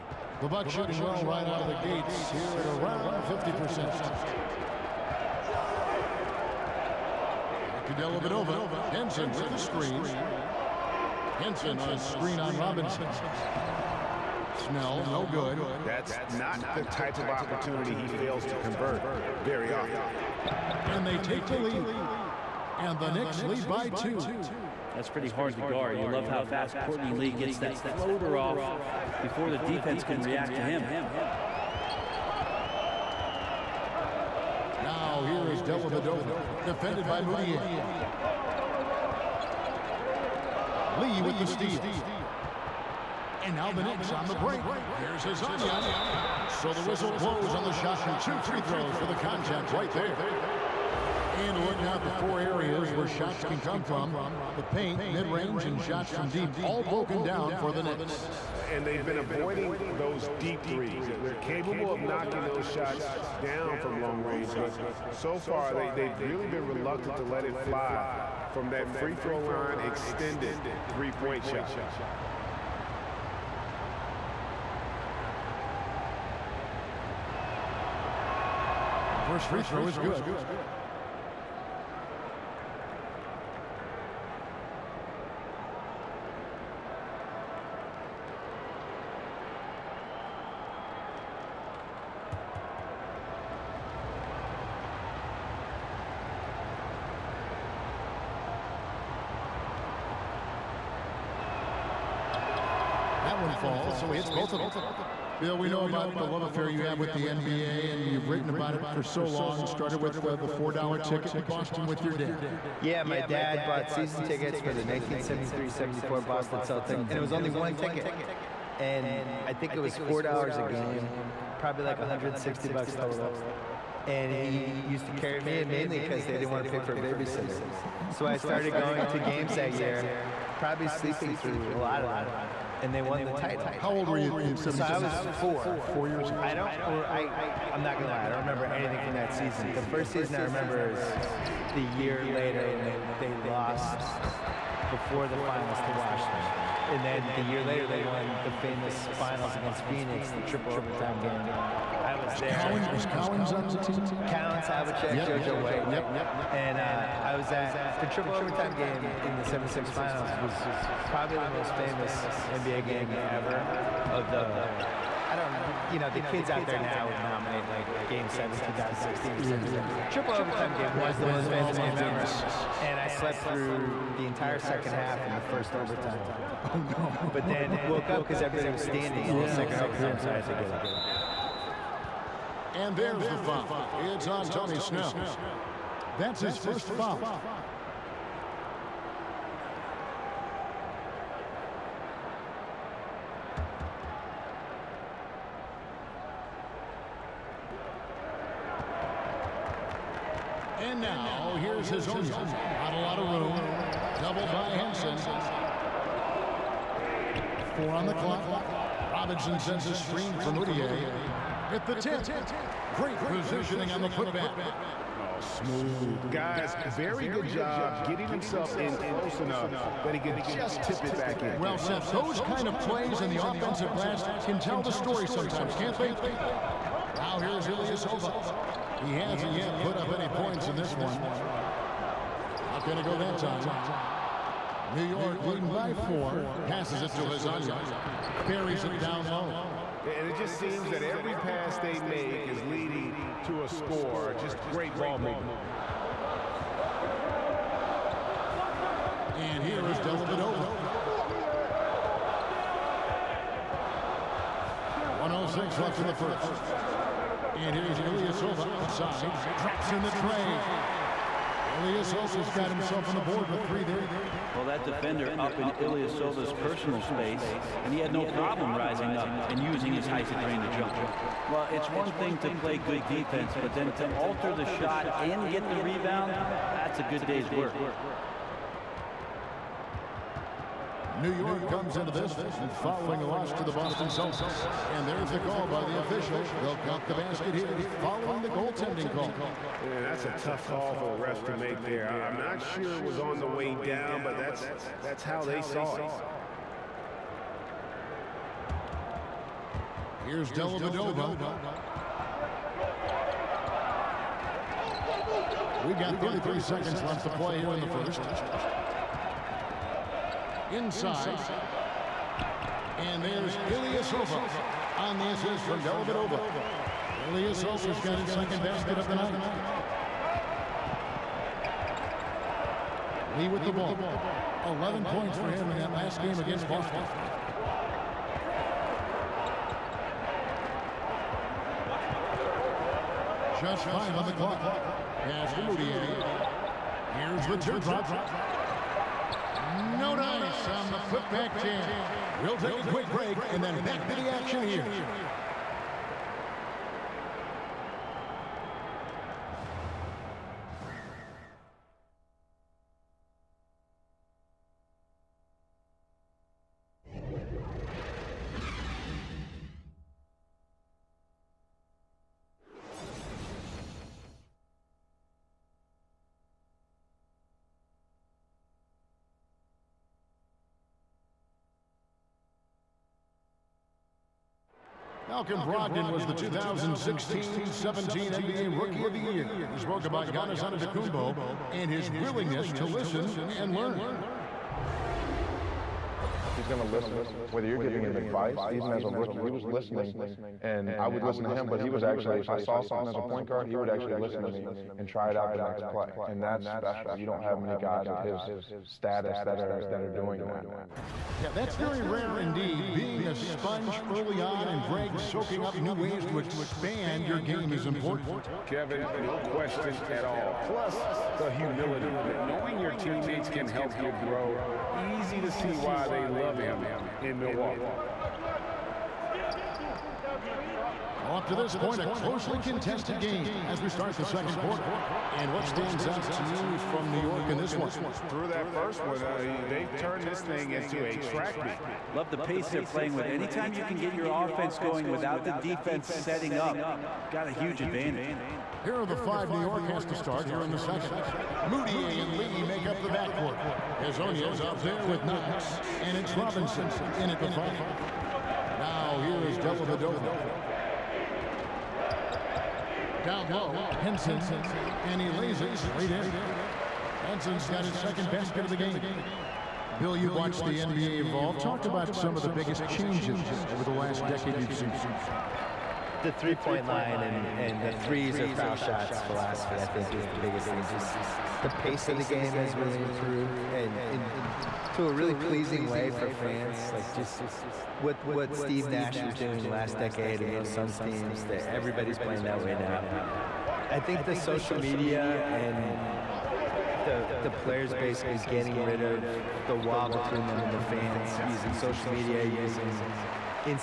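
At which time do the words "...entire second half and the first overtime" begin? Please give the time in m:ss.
2:54.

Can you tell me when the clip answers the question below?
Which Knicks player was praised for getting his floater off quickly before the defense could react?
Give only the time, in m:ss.
0:26.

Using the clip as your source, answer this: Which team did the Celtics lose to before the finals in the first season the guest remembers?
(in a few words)
Washington.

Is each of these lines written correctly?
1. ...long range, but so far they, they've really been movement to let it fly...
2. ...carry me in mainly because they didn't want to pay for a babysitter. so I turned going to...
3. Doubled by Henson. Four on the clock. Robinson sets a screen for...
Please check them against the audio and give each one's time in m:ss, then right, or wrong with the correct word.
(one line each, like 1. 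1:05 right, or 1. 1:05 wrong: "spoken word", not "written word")
1. 1:04 wrong: "reluctant", not "movement"
2. 2:05 wrong: "started", not "turned"
3. 3:24 right.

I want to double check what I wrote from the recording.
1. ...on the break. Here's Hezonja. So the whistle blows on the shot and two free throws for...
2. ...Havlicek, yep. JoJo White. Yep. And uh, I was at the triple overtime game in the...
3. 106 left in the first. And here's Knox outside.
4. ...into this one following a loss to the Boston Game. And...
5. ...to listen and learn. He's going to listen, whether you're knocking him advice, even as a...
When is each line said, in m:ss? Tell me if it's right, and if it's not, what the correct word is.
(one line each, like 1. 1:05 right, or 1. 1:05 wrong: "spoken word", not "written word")
1. 0:44 right
2. 2:34 right
3. 4:15 wrong: "Ilyasova", not "Knox"
4. 4:41 wrong: "Celtics", not "Game"
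5. 6:22 wrong: "giving", not "knocking".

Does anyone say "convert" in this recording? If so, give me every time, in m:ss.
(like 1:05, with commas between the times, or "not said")
0:18.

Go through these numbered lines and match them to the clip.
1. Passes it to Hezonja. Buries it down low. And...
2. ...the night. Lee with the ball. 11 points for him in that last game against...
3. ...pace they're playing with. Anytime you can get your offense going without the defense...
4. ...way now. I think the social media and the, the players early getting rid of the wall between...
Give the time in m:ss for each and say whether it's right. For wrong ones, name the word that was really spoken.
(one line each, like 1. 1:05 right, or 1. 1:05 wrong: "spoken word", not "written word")
1. 3:56 right
2. 5:19 right
3. 7:12 right
4. 8:02 wrong: "basically", not "early".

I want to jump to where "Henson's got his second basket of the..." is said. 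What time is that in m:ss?
7:37.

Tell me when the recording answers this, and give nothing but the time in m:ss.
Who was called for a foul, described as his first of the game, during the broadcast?
3:04.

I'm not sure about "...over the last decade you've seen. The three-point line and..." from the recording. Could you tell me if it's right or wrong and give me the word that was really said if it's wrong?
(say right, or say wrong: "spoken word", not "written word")
right.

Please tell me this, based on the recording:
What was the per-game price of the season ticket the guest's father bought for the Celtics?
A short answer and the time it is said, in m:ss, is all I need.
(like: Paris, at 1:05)
$4, at 2:00.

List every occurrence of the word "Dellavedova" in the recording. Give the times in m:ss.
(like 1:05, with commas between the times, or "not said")
0:07, 0:35, 5:00, 5:15, 7:29.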